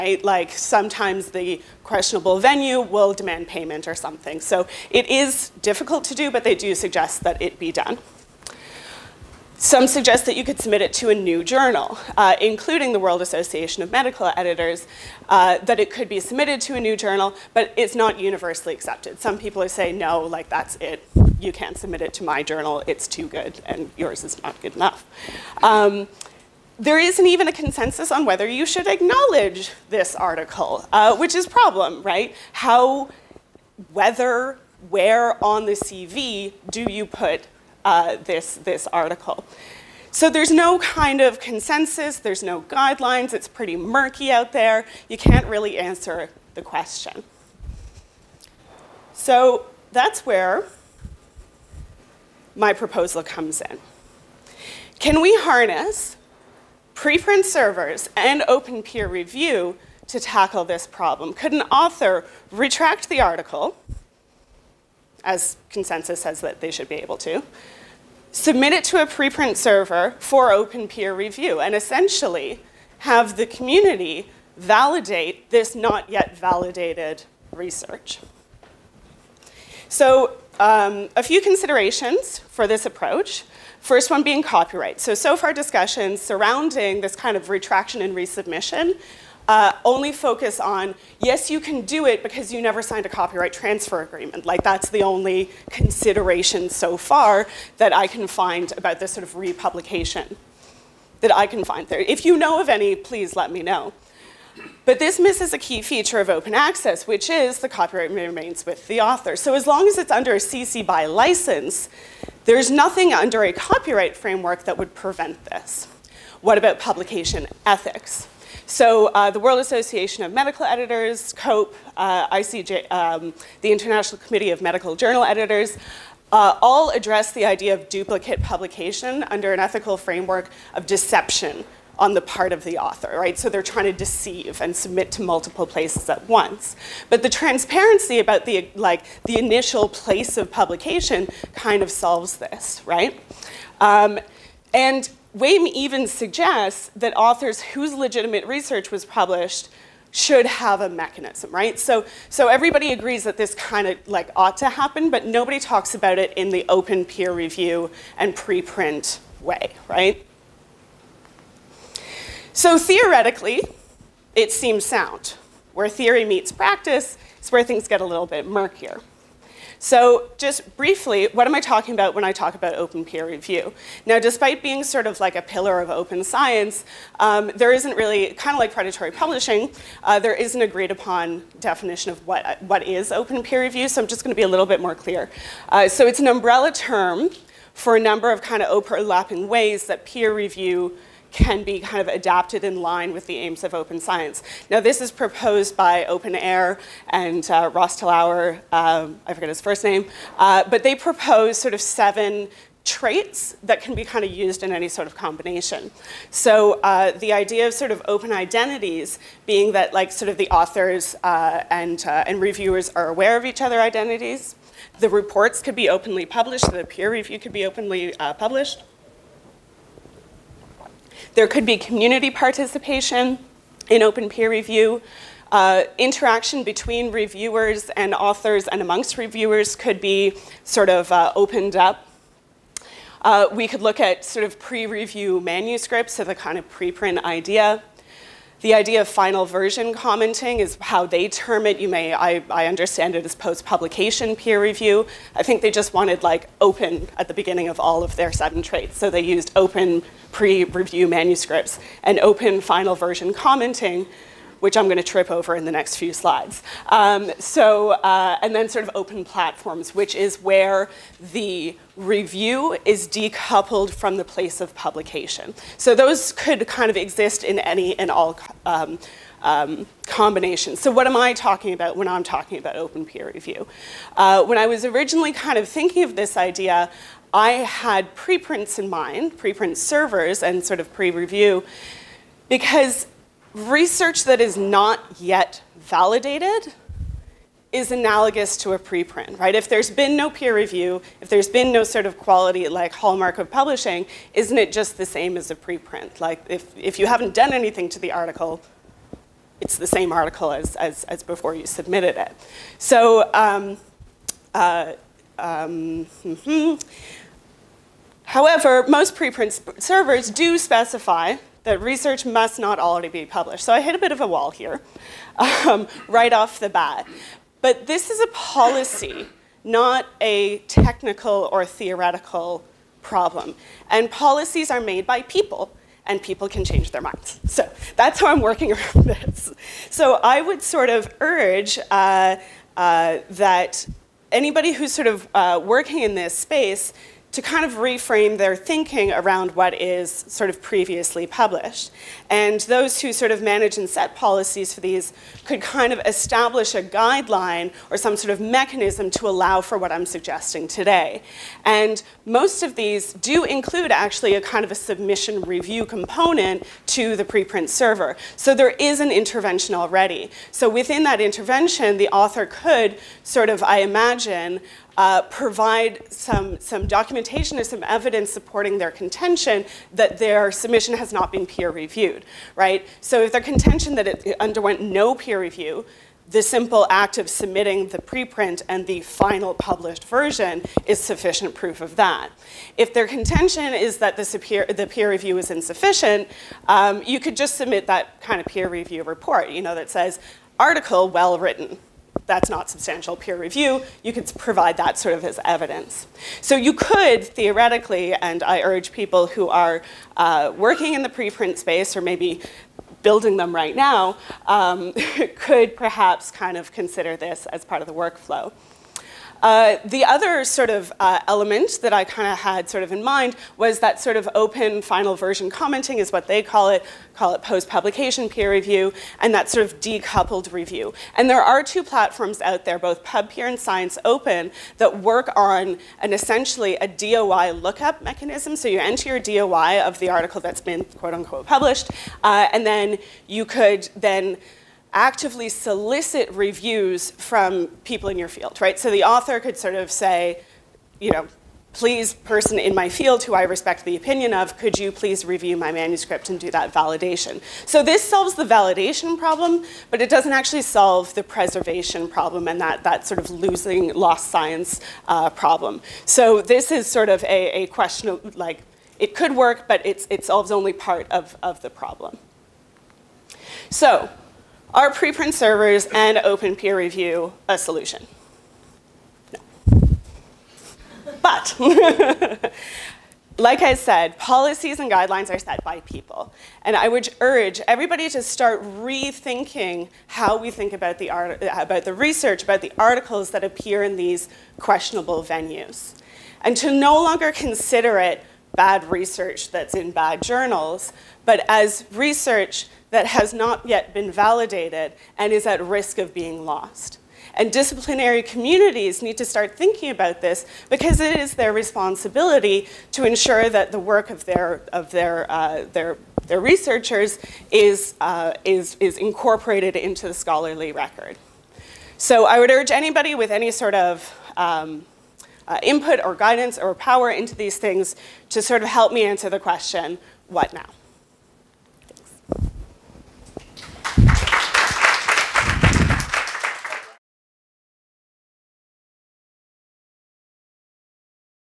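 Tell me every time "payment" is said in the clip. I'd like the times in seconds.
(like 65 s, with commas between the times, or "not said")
3 s.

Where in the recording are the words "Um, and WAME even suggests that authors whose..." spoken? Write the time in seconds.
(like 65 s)
143 s.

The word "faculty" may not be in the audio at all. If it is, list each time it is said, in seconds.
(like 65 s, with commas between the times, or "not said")
not said.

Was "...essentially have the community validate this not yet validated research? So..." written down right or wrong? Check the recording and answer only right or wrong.
right.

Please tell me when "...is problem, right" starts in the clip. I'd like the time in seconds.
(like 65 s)
31 s.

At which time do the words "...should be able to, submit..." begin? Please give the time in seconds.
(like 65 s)
66 s.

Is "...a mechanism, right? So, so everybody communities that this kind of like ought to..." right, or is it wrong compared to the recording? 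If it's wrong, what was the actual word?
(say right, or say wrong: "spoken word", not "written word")
wrong: "agrees", not "communities".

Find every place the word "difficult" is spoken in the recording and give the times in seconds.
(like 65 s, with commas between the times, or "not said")
5 s.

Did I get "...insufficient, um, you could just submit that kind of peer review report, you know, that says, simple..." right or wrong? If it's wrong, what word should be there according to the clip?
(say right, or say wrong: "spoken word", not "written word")
wrong: "article", not "simple".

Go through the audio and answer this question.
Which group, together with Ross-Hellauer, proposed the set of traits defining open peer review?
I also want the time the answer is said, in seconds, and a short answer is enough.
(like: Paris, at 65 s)
OpenAIRE, at 196 s.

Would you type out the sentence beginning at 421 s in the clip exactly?
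And there are two platforms out there, both PubPeer and ScienceOpen, that work on an essentially a DOI lookup mechanism.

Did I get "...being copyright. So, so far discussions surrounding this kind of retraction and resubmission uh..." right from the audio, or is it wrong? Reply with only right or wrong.
right.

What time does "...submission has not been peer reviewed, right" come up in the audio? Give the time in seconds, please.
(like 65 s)
370 s.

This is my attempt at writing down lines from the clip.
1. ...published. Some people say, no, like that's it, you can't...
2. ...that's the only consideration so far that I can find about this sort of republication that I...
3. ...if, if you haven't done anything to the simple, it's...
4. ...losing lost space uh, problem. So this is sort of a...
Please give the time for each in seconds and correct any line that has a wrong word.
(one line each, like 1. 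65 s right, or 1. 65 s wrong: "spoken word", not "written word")
1. 18 s wrong: "accepted", not "published"
2. 94 s right
3. 296 s wrong: "article", not "simple"
4. 453 s wrong: "science", not "space".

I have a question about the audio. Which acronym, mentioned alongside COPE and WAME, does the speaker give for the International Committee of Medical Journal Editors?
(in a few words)
ICJ.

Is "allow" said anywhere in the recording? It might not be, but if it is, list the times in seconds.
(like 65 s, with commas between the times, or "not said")
349 s.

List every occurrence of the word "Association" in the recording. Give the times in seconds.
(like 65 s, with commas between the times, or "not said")
13 s, 119 s.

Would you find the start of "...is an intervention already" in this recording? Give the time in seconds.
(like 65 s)
358 s.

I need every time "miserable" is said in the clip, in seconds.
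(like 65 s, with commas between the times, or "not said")
not said.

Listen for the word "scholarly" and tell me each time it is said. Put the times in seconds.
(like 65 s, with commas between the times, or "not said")
510 s.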